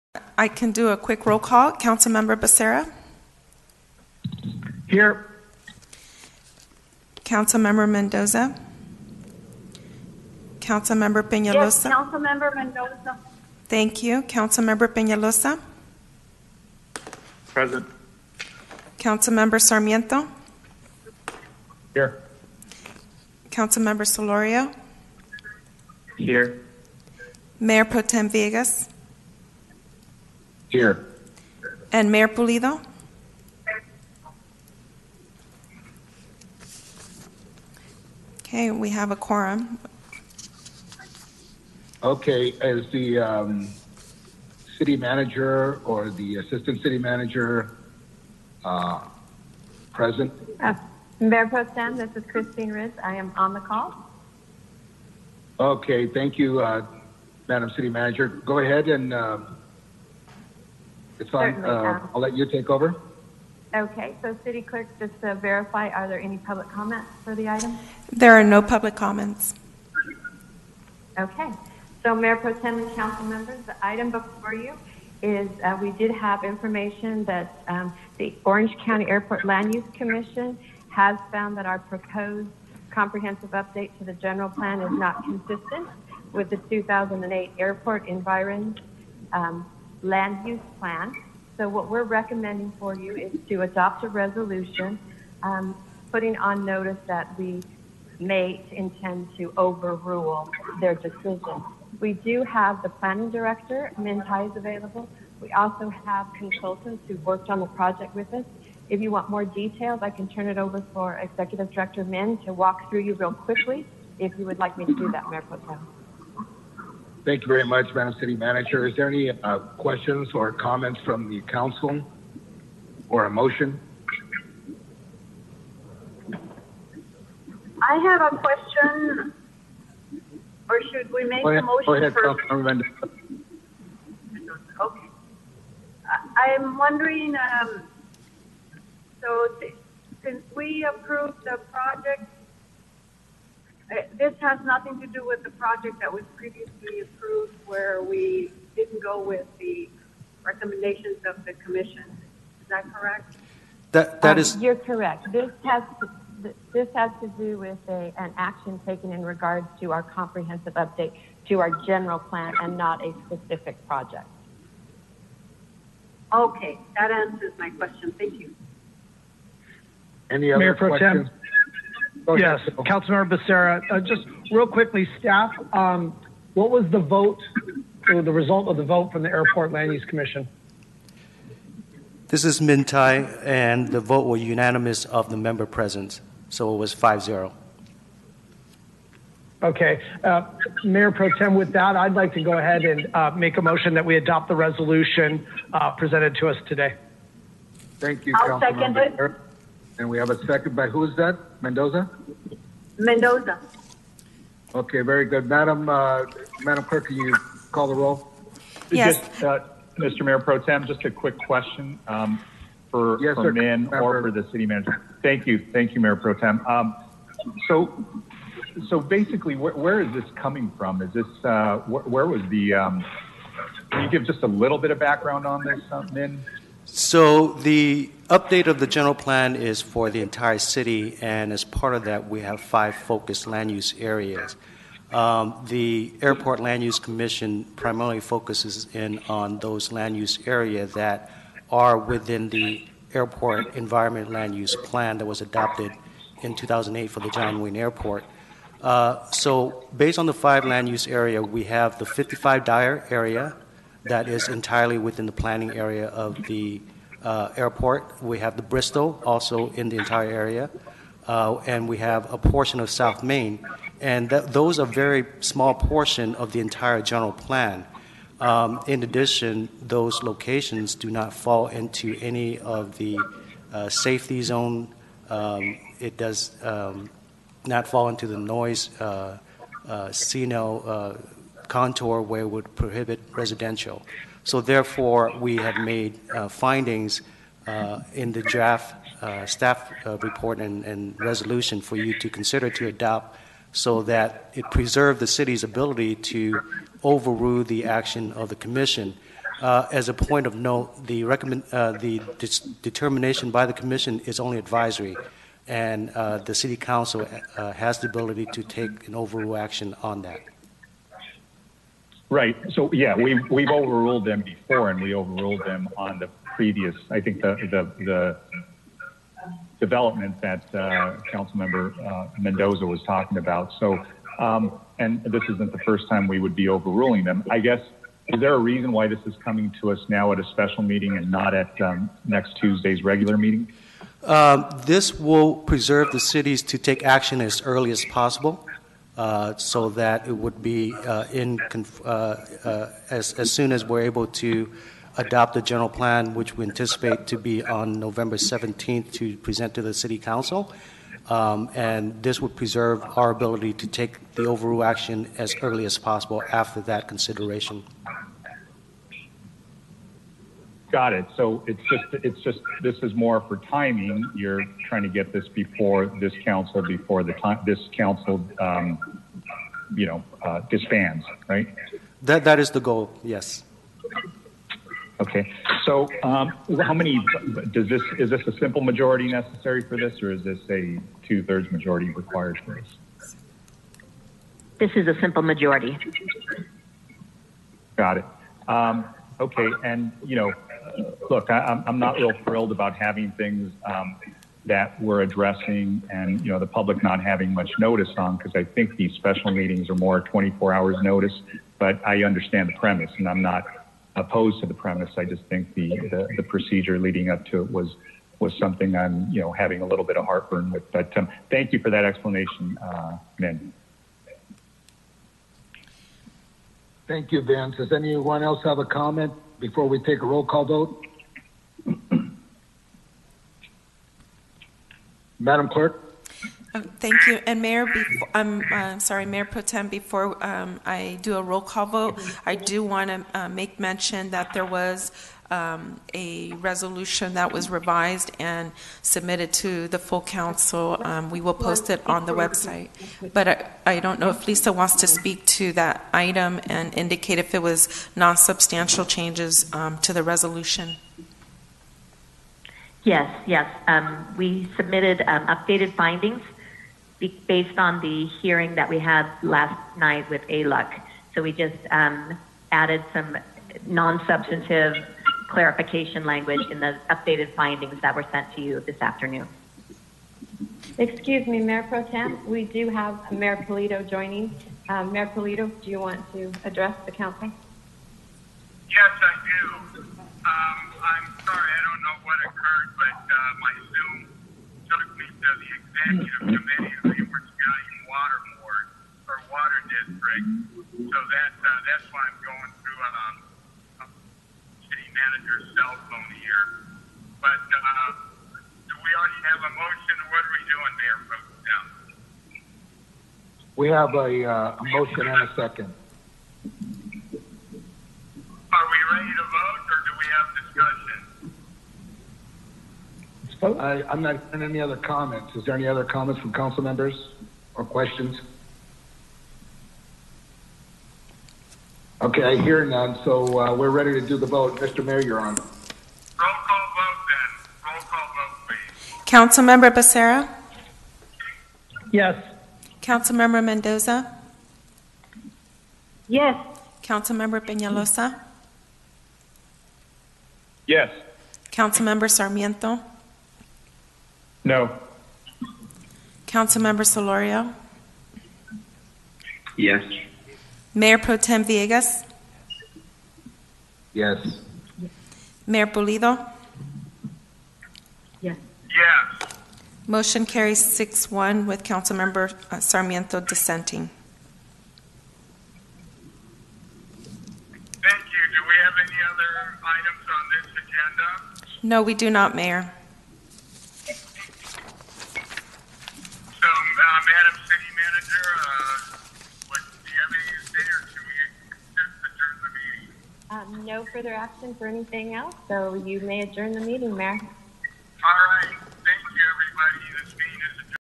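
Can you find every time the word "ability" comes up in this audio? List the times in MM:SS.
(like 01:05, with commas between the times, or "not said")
04:55, 05:08, 05:53.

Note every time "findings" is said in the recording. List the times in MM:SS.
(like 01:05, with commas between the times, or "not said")
04:46, 07:35, 07:47.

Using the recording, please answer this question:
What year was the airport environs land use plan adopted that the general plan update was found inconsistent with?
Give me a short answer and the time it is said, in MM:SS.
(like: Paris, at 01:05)
2008, at 01:26.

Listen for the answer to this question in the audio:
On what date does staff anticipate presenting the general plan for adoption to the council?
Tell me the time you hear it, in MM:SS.
05:47.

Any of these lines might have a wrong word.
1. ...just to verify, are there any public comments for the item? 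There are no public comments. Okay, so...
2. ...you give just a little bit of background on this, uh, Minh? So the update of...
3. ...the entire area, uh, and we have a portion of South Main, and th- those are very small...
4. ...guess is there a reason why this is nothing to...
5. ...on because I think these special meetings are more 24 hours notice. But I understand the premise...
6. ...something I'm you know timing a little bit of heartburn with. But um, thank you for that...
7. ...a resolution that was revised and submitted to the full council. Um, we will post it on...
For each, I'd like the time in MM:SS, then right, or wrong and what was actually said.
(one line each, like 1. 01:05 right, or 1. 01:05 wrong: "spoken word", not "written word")
1. 01:04 right
2. 03:44 right
3. 04:19 right
4. 05:27 wrong: "coming", not "nothing"
5. 06:38 right
6. 06:48 wrong: "having", not "timing"
7. 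07:16 right.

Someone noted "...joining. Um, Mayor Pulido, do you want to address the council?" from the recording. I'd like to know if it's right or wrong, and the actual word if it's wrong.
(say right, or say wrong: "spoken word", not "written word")
right.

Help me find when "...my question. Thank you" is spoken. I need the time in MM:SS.
02:47.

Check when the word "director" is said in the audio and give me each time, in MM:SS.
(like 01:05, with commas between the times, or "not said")
01:43, 01:51.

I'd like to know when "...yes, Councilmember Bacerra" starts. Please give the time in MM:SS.
02:52.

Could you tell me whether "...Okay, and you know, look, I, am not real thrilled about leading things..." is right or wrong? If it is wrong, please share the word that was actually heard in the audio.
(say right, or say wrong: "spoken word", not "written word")
wrong: "having", not "leading".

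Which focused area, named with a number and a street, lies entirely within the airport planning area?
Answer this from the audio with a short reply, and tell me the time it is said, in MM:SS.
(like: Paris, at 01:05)
55 Dyer, at 04:12.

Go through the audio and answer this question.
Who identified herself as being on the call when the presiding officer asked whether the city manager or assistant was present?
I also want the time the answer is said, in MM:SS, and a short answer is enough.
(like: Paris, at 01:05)
Kristine Ridge, at 00:52.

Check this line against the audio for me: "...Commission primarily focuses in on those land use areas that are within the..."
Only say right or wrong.
right.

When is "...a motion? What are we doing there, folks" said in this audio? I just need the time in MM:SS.
08:19.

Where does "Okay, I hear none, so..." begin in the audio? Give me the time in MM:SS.
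08:42.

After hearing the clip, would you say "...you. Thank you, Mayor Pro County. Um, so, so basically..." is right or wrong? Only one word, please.
wrong.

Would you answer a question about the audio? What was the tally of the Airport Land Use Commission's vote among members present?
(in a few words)
5-0.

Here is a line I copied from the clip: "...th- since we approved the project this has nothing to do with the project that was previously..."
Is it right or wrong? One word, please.
right.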